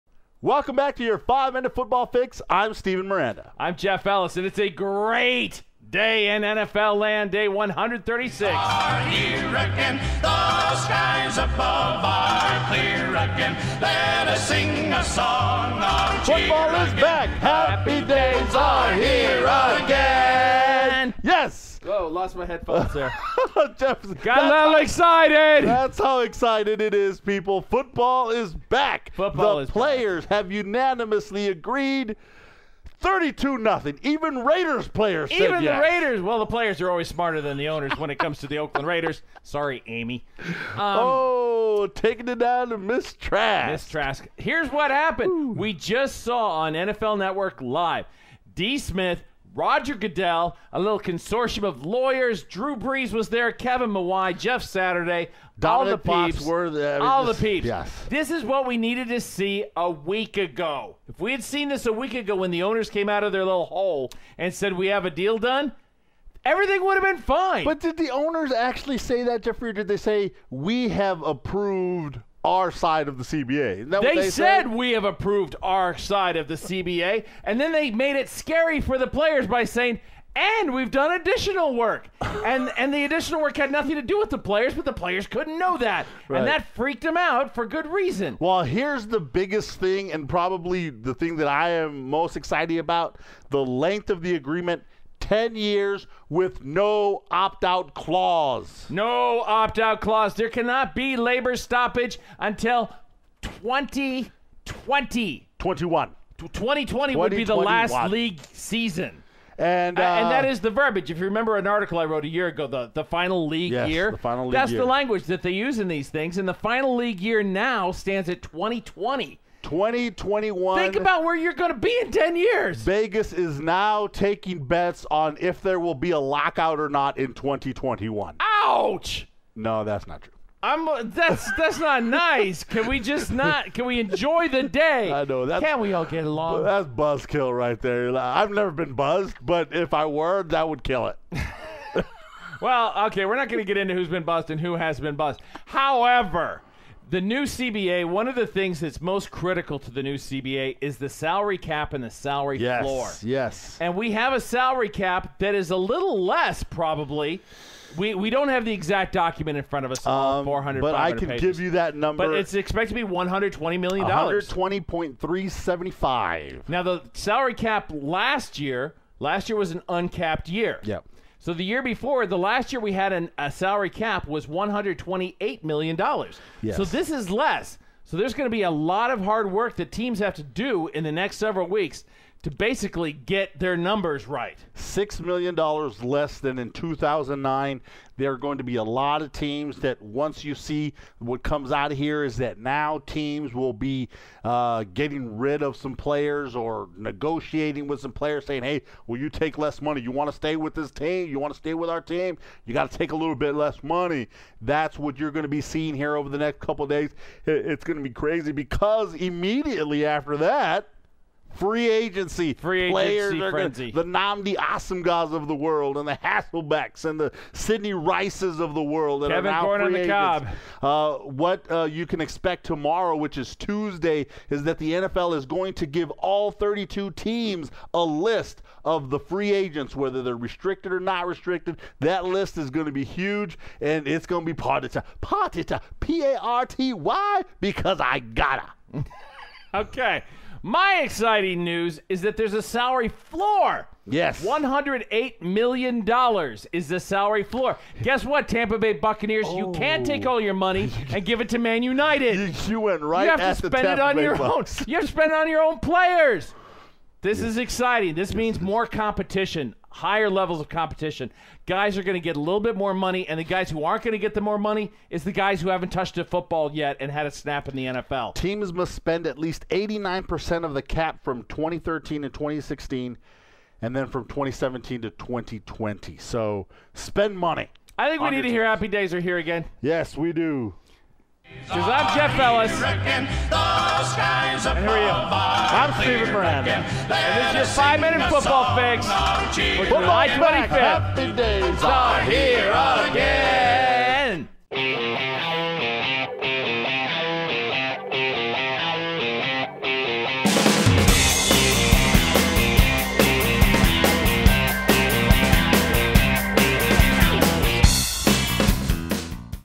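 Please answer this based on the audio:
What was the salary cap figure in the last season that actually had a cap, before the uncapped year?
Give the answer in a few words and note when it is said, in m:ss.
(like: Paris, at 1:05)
$128 million, at 2:54.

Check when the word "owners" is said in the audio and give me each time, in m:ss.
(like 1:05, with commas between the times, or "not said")
0:37, 1:02, 1:08.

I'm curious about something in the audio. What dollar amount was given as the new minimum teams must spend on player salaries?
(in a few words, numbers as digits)
$108 million.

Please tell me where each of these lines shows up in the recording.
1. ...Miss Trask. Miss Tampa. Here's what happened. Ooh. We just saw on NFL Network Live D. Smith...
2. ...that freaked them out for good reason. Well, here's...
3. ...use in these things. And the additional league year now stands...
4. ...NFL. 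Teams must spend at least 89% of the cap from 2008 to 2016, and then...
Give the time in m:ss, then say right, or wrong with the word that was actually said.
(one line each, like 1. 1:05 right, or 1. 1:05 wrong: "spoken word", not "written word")
1. 0:42 wrong: "Trask", not "Tampa"
2. 1:26 right
3. 1:55 wrong: "final", not "additional"
4. 4:27 wrong: "2013", not "2008".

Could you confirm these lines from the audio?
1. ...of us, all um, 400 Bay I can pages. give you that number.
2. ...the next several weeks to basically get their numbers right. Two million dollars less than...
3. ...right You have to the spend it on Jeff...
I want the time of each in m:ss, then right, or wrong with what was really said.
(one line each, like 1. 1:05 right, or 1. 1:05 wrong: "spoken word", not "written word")
1. 2:39 wrong: "But", not "Bay"
2. 3:01 wrong: "Six", not "Two"
3. 4:13 wrong: "Bay", not "Jeff".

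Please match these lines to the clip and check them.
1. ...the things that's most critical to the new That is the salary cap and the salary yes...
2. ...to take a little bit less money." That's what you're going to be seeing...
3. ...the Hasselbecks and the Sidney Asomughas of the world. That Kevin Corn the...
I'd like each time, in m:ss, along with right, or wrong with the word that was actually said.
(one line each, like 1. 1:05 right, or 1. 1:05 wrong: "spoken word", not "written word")
1. 2:28 wrong: "CBA", not "That"
2. 3:22 right
3. 3:36 wrong: "Rices", not "Asomughas".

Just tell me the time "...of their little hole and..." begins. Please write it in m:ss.
1:03.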